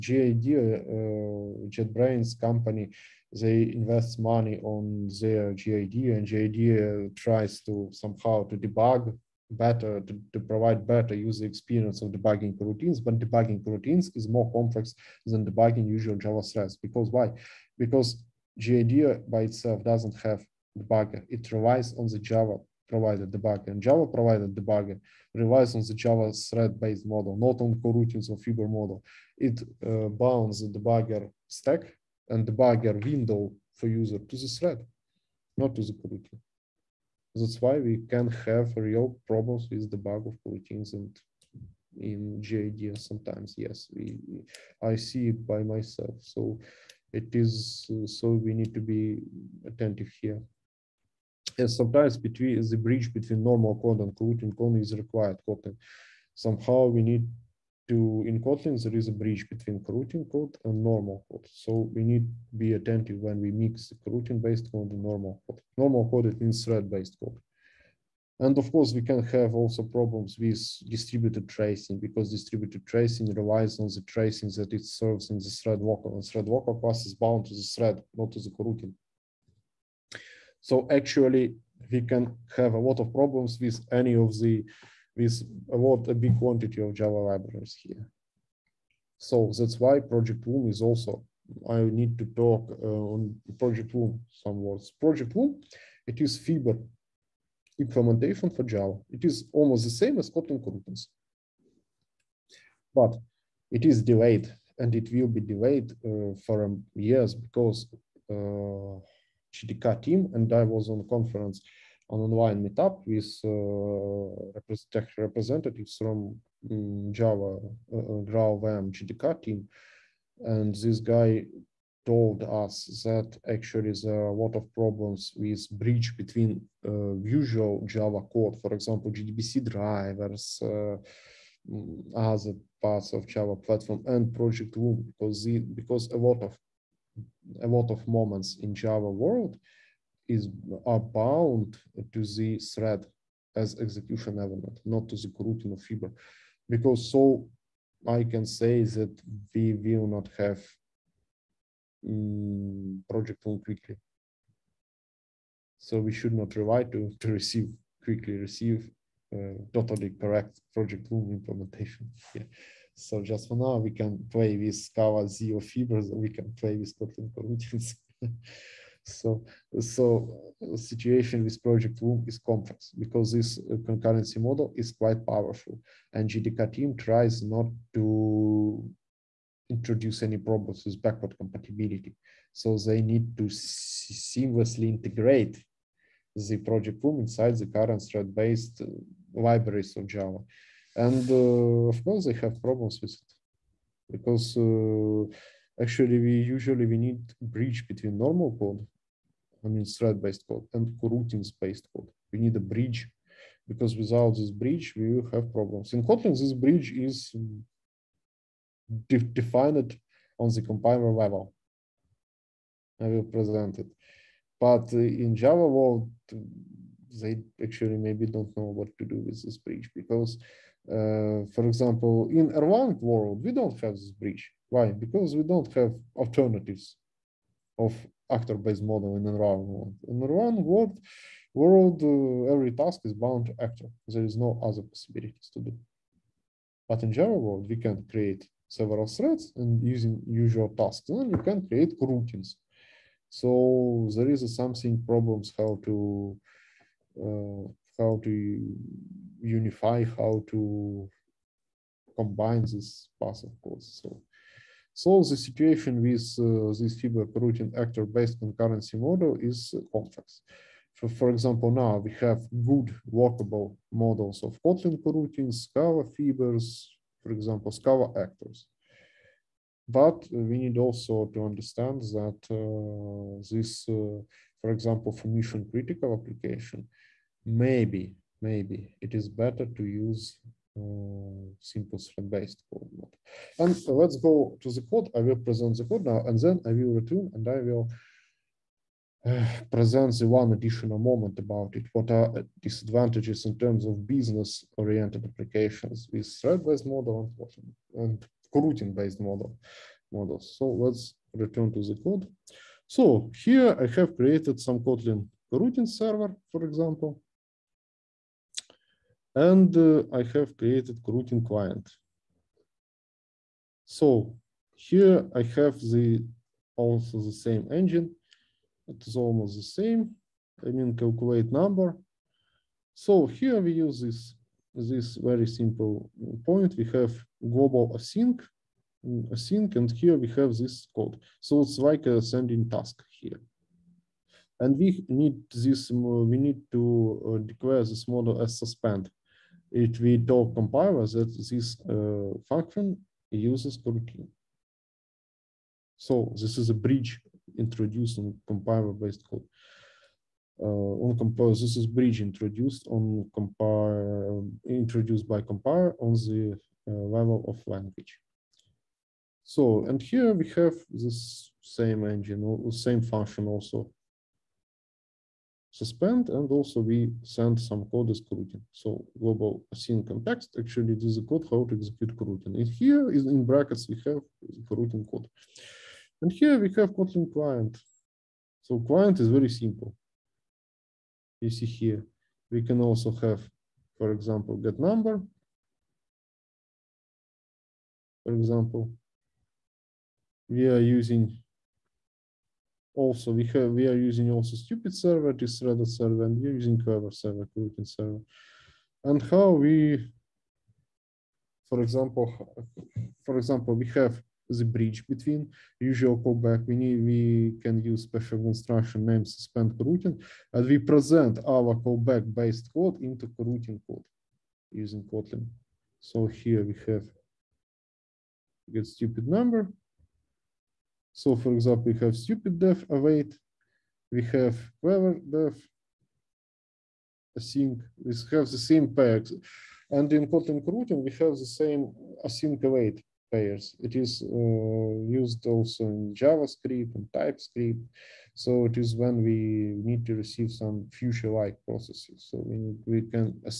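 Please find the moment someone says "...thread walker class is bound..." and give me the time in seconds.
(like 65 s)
76 s.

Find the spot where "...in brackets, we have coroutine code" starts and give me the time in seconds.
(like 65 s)
373 s.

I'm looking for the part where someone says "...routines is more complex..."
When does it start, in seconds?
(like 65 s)
13 s.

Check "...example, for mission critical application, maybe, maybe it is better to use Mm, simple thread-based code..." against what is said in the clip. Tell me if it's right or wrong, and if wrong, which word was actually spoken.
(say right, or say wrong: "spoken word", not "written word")
right.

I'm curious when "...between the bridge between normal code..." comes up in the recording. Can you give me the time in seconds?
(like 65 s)
52 s.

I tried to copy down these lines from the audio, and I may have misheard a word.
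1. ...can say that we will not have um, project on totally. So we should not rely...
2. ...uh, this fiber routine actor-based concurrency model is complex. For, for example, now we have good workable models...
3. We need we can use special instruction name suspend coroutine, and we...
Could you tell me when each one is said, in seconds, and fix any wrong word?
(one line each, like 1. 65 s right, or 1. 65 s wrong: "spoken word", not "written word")
1. 148 s wrong: "quickly", not "totally"
2. 256 s right
3. 406 s right.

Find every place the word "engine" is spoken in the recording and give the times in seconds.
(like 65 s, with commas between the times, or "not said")
317 s, 362 s.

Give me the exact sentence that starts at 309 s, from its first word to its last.
And uh, I have created coroutine client.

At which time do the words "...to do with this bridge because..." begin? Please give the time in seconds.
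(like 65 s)
218 s.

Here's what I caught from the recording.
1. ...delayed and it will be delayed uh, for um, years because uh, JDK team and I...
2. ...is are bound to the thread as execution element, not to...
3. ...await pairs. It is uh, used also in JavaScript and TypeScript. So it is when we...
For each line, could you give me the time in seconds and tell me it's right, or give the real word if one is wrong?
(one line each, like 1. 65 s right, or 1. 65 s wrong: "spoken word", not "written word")
1. 104 s right
2. 140 s right
3. 432 s right.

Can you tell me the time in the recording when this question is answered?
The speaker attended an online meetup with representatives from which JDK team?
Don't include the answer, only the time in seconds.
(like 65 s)
118 s.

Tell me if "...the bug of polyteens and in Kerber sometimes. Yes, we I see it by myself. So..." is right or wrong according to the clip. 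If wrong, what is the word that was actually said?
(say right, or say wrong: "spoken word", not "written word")
wrong: "JIDs", not "Kerber".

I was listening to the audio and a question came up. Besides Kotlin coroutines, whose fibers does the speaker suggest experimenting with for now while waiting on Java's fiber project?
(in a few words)
Scala ZIO.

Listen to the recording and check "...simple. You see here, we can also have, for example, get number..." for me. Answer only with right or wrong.
right.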